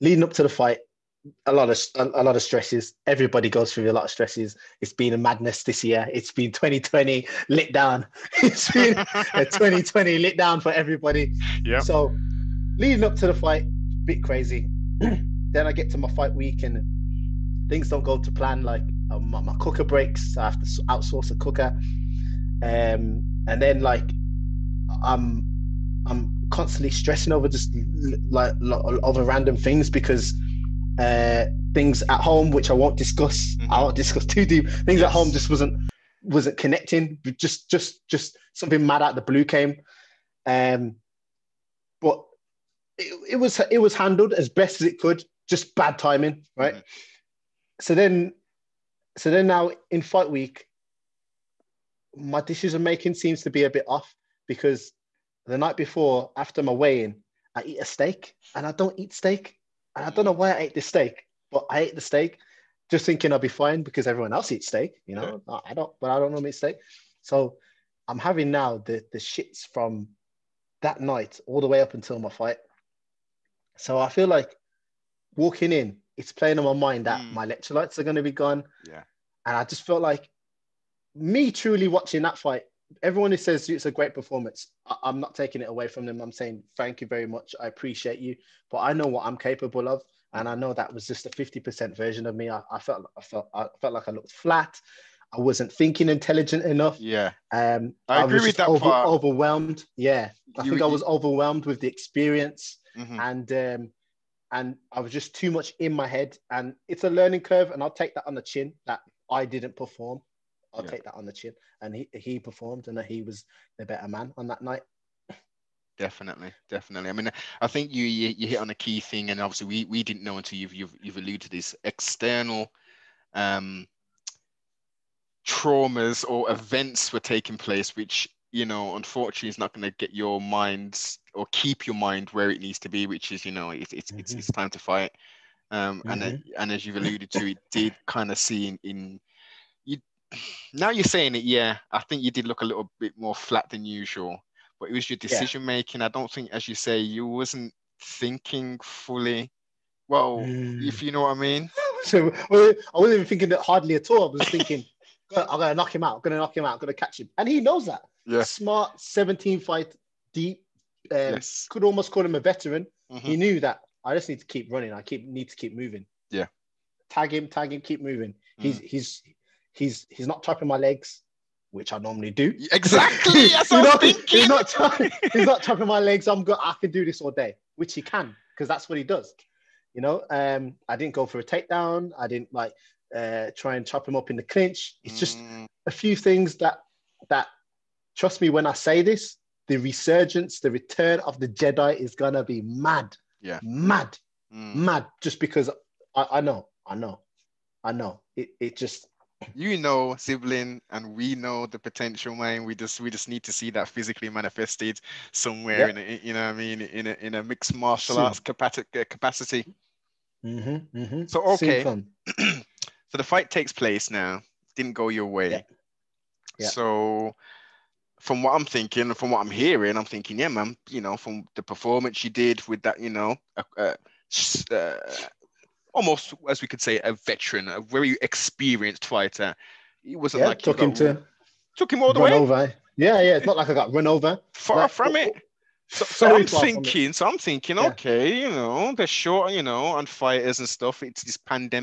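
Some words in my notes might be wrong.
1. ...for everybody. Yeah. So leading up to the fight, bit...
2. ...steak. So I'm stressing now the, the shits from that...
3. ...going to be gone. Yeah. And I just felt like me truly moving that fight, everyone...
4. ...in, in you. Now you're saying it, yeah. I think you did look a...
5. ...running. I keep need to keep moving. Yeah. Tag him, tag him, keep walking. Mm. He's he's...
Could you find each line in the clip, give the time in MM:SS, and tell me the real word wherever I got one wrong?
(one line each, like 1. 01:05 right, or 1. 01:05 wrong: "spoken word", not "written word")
1. 00:10 right
2. 01:06 wrong: "having", not "stressing"
3. 01:18 wrong: "watching", not "moving"
4. 02:18 right
5. 02:44 wrong: "moving", not "walking".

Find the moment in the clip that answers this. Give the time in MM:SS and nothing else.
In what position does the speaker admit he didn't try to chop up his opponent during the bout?
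03:04.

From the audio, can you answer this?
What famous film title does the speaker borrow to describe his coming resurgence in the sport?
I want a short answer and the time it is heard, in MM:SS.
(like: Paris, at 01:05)
Return of the Jedi, at 03:10.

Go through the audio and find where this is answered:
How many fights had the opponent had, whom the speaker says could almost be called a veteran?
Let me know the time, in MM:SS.
02:39.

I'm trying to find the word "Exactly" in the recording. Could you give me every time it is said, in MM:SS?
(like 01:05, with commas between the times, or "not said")
02:52.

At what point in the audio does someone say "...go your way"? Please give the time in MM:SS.
03:34.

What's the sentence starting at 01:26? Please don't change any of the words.
I'm saying thank you very much.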